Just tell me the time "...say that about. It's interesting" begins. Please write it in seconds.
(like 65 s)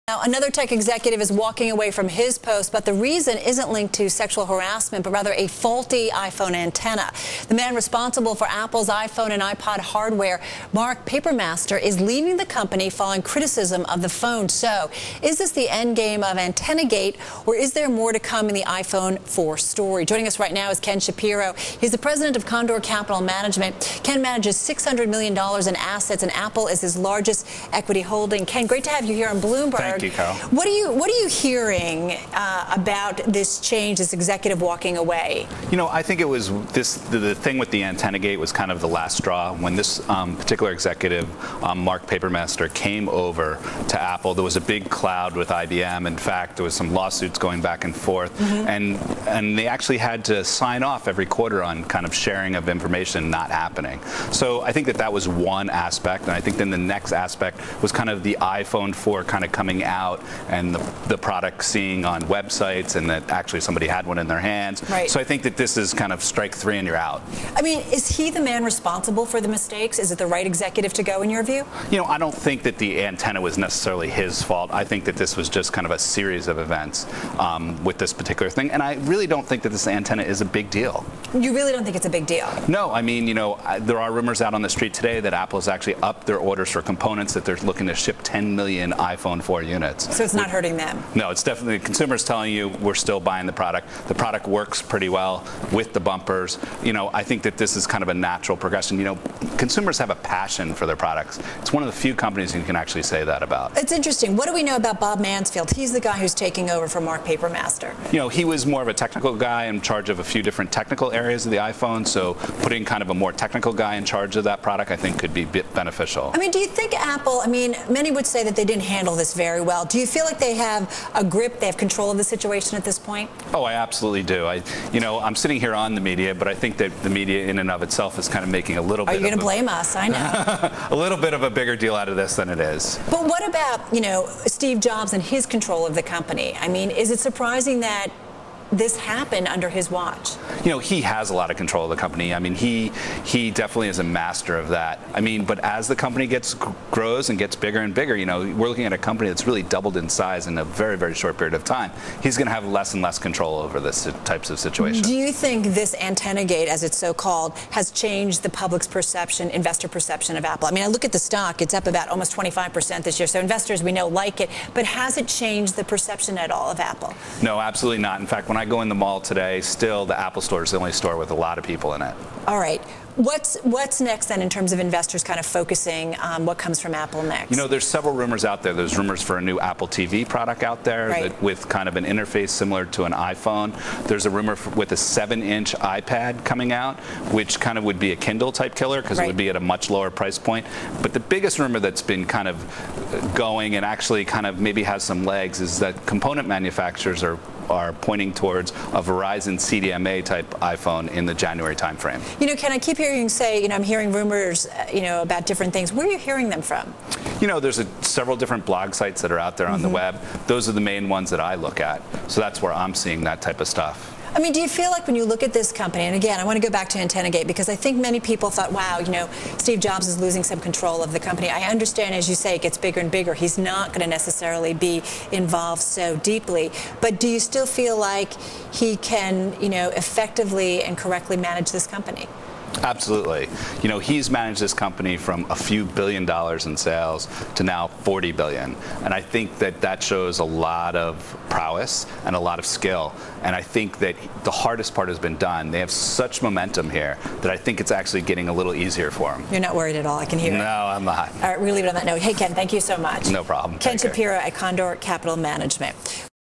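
103 s.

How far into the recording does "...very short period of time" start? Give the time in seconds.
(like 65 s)
150 s.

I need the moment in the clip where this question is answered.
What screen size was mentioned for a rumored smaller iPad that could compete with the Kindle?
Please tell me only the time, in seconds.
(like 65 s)
184 s.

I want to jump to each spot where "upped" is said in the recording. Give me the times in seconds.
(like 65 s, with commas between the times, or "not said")
85 s.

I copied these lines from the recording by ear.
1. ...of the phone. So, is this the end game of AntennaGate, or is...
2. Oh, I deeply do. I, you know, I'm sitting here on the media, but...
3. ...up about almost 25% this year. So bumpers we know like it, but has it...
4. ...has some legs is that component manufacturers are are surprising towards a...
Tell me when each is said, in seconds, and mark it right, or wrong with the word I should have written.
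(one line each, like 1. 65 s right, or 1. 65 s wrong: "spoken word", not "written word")
1. 13 s right
2. 123 s wrong: "absolutely", not "deeply"
3. 161 s wrong: "investors", not "bumpers"
4. 194 s wrong: "pointing", not "surprising".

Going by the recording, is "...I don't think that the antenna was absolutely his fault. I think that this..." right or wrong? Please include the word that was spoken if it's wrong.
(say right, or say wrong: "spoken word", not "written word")
wrong: "necessarily", not "absolutely".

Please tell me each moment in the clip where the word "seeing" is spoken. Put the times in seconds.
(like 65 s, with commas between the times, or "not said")
61 s, 212 s.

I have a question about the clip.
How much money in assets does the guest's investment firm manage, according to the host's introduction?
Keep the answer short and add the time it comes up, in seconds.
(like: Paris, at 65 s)
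$600 million, at 24 s.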